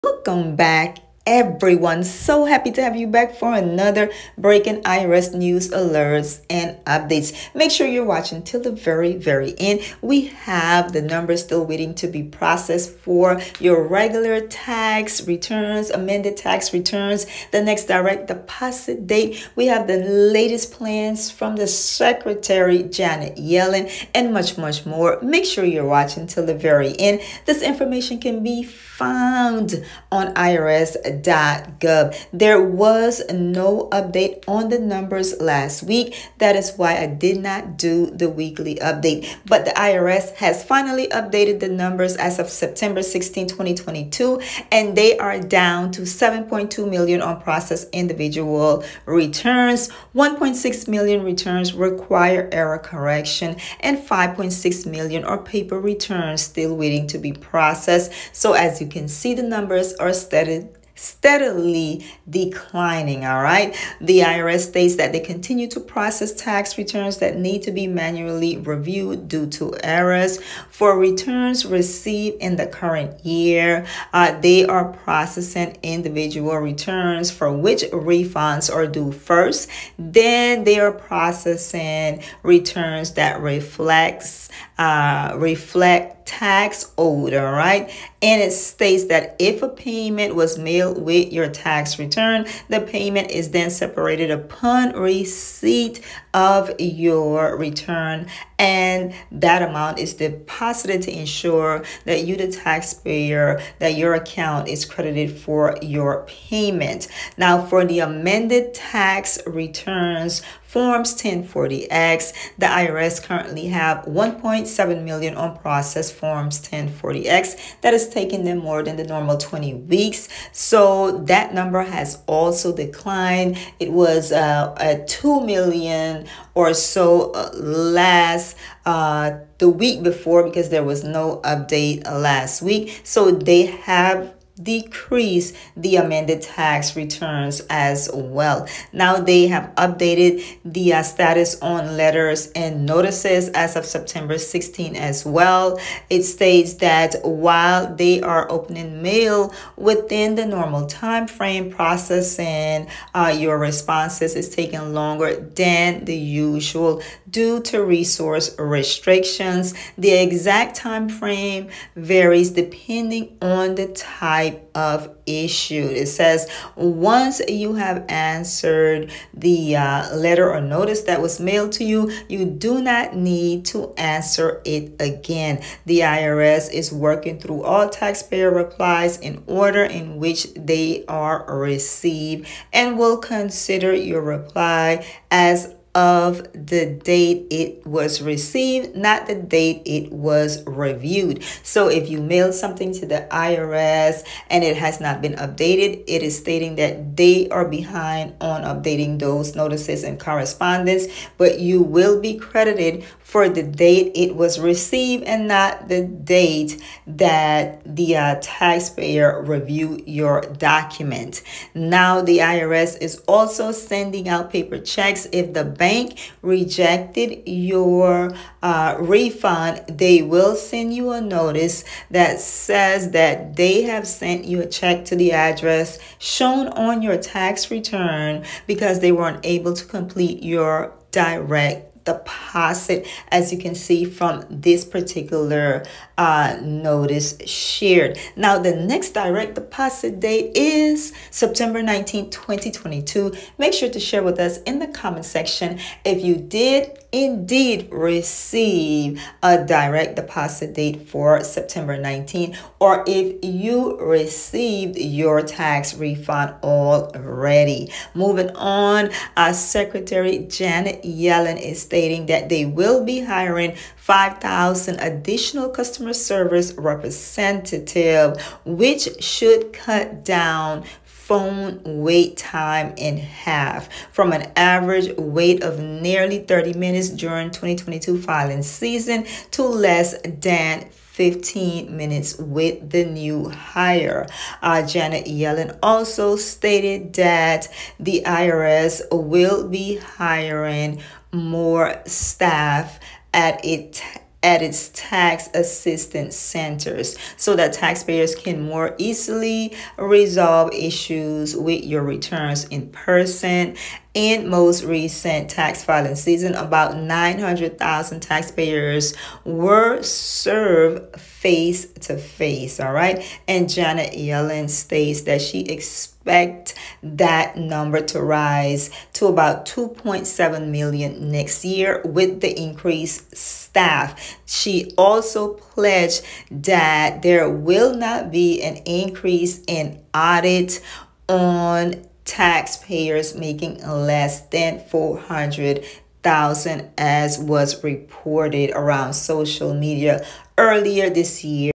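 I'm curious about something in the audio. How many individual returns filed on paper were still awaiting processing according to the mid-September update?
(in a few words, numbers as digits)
5.6 million.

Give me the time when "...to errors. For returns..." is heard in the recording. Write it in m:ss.
1:09.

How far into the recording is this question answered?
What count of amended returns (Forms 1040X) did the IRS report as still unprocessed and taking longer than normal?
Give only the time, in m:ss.
1:54.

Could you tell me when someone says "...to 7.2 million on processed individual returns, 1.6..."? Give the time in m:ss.
0:45.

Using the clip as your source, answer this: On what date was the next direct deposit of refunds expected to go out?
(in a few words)
September 19, 2022.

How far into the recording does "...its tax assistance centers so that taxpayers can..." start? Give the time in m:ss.
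4:54.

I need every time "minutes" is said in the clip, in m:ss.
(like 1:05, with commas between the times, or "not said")
4:36, 4:41.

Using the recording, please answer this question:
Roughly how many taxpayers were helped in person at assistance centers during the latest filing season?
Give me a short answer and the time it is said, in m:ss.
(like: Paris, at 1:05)
900,000, at 5:06.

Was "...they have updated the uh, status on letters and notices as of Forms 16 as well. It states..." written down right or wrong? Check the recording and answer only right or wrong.
wrong.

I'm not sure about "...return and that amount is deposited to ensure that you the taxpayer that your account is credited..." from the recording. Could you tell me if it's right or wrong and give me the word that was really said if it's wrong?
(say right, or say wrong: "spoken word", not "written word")
right.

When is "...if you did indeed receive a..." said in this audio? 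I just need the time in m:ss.
4:06.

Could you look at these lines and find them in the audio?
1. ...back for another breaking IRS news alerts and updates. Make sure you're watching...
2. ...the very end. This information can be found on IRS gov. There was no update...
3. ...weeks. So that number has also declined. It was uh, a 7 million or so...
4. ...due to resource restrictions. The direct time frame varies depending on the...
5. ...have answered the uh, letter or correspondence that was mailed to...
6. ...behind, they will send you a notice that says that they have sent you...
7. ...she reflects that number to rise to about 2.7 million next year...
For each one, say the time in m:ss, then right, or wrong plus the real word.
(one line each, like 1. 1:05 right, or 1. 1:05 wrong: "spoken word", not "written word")
1. 0:03 right
2. 0:26 right
3. 1:59 wrong: "2", not "7"
4. 2:37 wrong: "exact", not "direct"
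5. 2:47 wrong: "notice", not "correspondence"
6. 3:38 wrong: "refund", not "behind"
7. 5:15 wrong: "expects", not "reflects".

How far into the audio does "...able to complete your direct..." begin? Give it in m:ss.
3:49.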